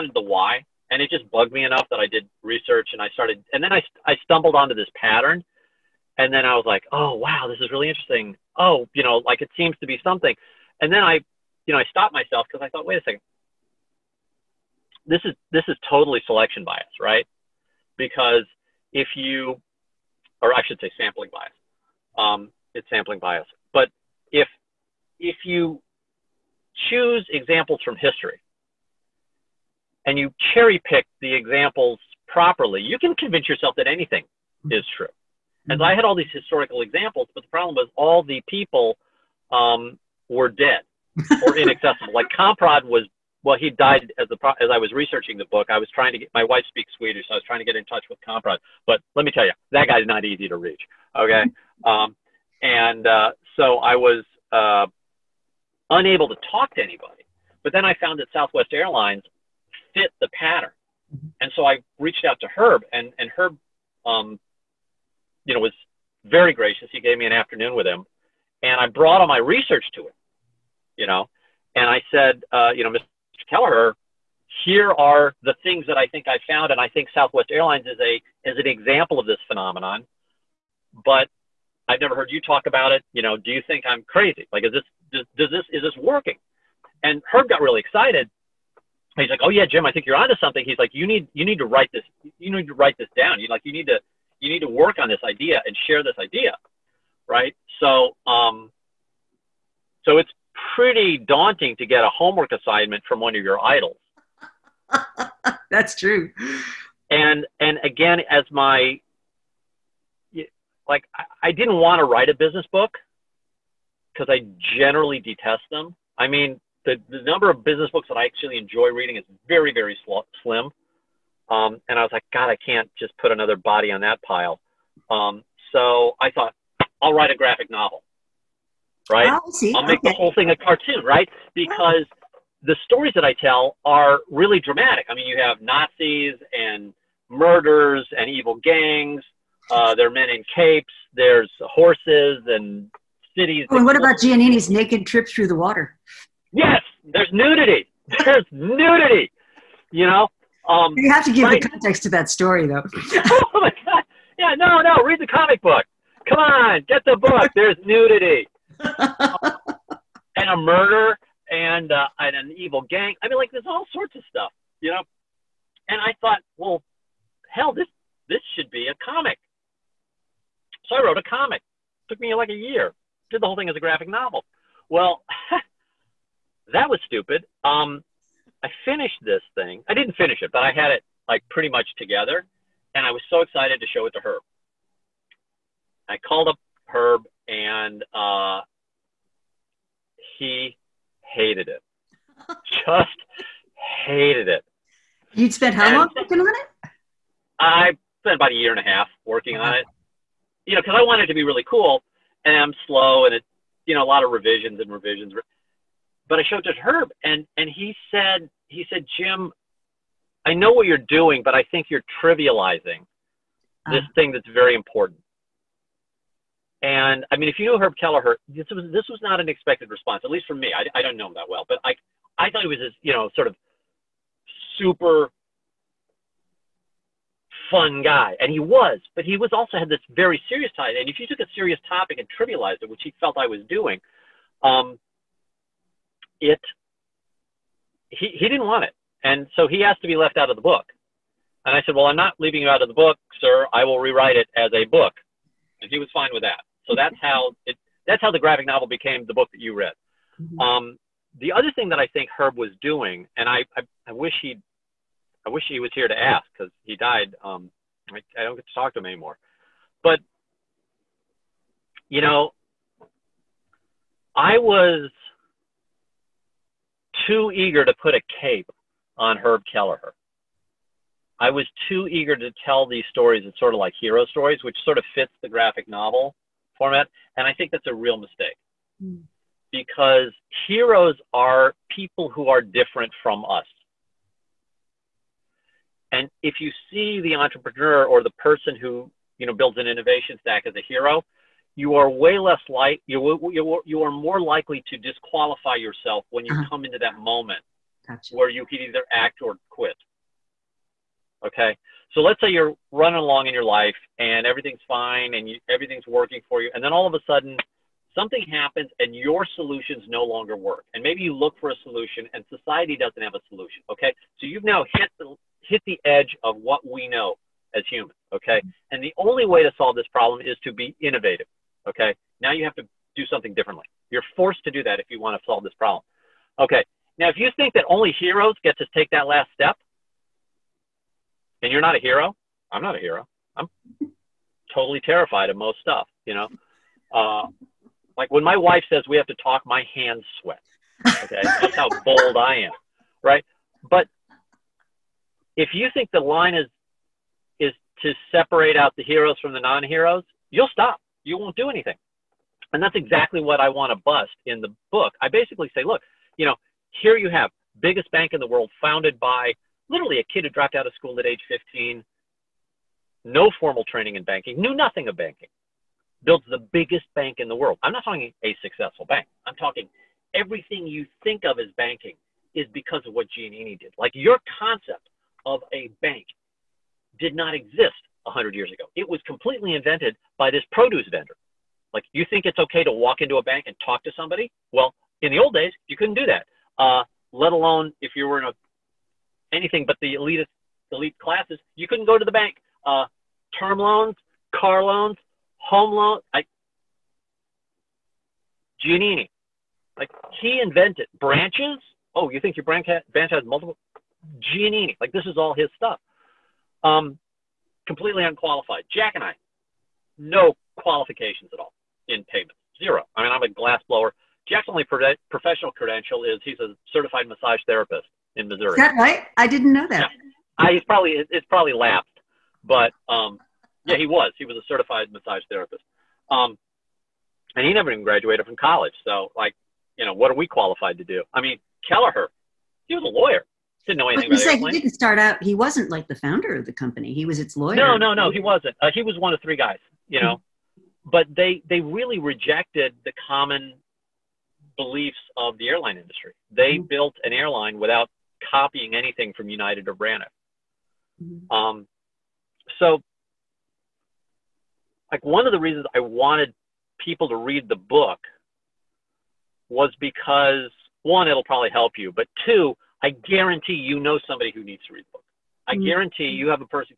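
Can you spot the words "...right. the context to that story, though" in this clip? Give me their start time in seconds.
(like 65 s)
151 s.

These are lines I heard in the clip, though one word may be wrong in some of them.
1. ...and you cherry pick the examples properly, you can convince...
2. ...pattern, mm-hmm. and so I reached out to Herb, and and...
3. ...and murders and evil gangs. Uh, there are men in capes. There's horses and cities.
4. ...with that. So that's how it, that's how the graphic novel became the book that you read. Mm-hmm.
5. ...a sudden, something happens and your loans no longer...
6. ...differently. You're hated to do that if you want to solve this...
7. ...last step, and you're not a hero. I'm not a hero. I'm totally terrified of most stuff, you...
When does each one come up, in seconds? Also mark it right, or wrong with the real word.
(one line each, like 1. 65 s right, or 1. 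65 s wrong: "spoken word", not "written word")
1. 30 s right
2. 60 s right
3. 136 s right
4. 246 s right
5. 307 s wrong: "solutions", not "loans"
6. 323 s wrong: "forced", not "hated"
7. 329 s right.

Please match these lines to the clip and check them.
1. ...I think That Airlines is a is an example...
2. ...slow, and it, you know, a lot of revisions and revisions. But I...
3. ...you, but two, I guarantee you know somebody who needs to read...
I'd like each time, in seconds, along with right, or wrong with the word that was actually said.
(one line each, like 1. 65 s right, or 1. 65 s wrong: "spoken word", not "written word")
1. 76 s wrong: "Southwest", not "That"
2. 202 s right
3. 461 s right.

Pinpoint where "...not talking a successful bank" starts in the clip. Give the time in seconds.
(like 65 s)
367 s.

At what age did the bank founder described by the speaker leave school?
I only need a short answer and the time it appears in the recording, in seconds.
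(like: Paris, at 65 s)
15, at 361 s.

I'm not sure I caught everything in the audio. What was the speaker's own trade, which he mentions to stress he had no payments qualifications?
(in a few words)
glass blower.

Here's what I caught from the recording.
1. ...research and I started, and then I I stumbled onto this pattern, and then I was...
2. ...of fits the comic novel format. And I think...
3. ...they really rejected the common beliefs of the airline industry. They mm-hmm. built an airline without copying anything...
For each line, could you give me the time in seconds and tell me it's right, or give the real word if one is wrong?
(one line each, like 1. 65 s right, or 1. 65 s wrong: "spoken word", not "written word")
1. 2 s right
2. 274 s wrong: "graphic", not "comic"
3. 441 s right.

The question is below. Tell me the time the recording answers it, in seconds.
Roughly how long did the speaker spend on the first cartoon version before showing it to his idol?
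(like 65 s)
198 s.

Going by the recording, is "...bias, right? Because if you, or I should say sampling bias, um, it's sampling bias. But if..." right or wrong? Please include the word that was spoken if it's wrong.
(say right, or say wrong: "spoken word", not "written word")
right.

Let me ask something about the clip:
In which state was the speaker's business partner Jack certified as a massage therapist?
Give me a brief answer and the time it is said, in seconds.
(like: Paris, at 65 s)
Missouri, at 418 s.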